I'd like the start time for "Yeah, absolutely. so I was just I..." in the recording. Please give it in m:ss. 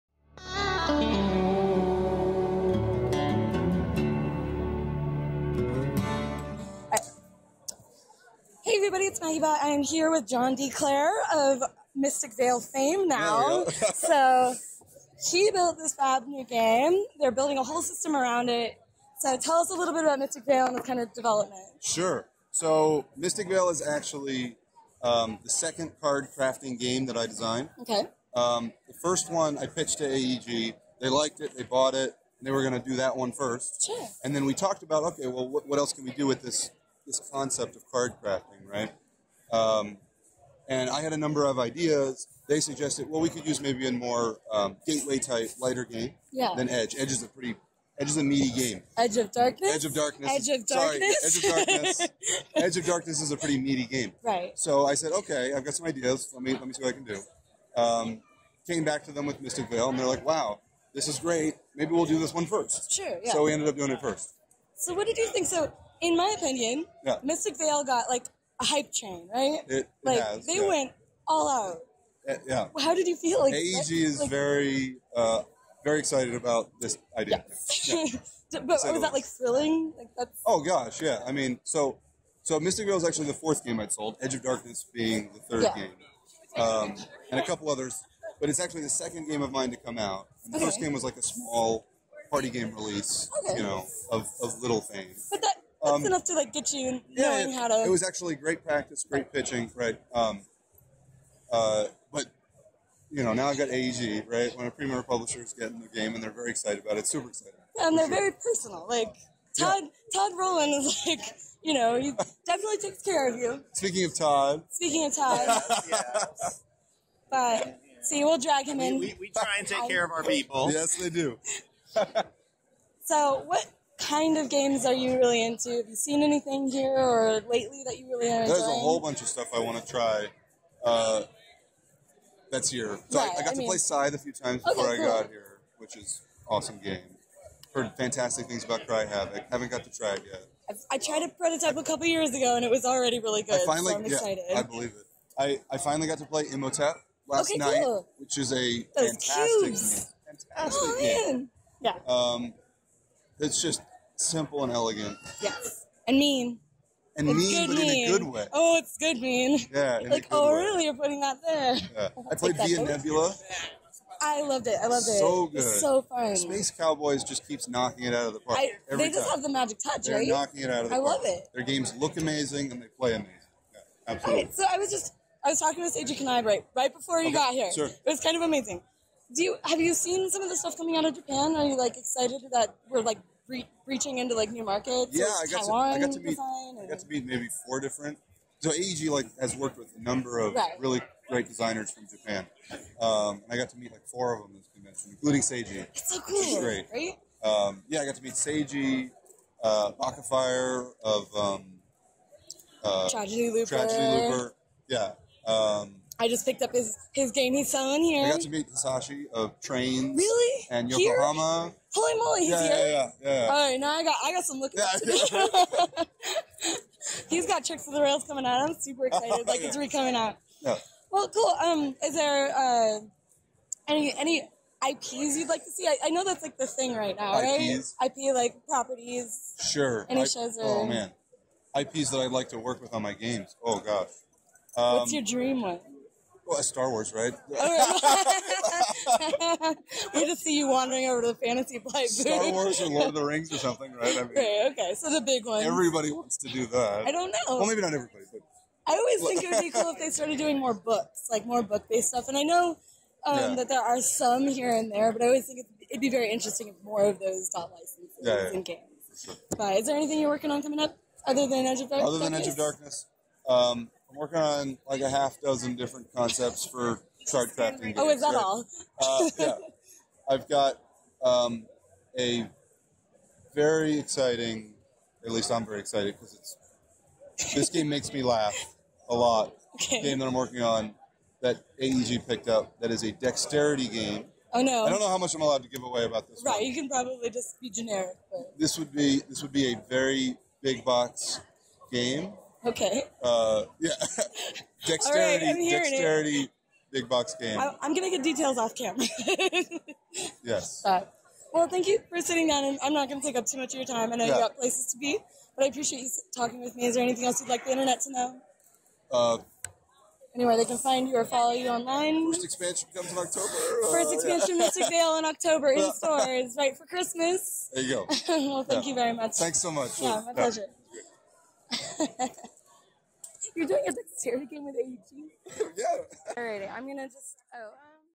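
2:53.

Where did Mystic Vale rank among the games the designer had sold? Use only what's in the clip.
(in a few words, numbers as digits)
Fourth.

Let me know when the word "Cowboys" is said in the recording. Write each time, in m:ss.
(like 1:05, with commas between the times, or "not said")
2:46.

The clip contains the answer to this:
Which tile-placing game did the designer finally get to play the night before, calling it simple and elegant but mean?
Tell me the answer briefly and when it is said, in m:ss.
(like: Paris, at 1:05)
Imhotep, at 2:26.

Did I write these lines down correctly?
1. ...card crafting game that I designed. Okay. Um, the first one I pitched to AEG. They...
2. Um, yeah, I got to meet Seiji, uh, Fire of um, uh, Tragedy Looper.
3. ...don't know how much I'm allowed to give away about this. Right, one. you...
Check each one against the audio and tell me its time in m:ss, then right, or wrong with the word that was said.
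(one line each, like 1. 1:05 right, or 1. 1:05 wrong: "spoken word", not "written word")
1. 0:26 right
2. 3:17 right
3. 4:44 right.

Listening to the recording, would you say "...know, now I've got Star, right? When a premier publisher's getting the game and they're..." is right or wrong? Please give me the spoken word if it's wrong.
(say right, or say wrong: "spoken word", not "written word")
wrong: "AEG", not "Star".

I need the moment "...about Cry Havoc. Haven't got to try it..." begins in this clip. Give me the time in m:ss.
2:18.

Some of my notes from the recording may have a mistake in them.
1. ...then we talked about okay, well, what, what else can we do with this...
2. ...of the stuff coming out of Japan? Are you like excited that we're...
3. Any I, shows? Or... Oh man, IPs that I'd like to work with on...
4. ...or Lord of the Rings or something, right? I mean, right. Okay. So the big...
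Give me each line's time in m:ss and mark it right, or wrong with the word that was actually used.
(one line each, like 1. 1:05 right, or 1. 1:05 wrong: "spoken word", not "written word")
1. 0:34 right
2. 3:00 right
3. 3:50 right
4. 4:02 right.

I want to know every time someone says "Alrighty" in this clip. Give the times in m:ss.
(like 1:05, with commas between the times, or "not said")
5:26.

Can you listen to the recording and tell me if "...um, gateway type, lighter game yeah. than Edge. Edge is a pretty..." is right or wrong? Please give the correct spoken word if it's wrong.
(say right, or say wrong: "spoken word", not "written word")
right.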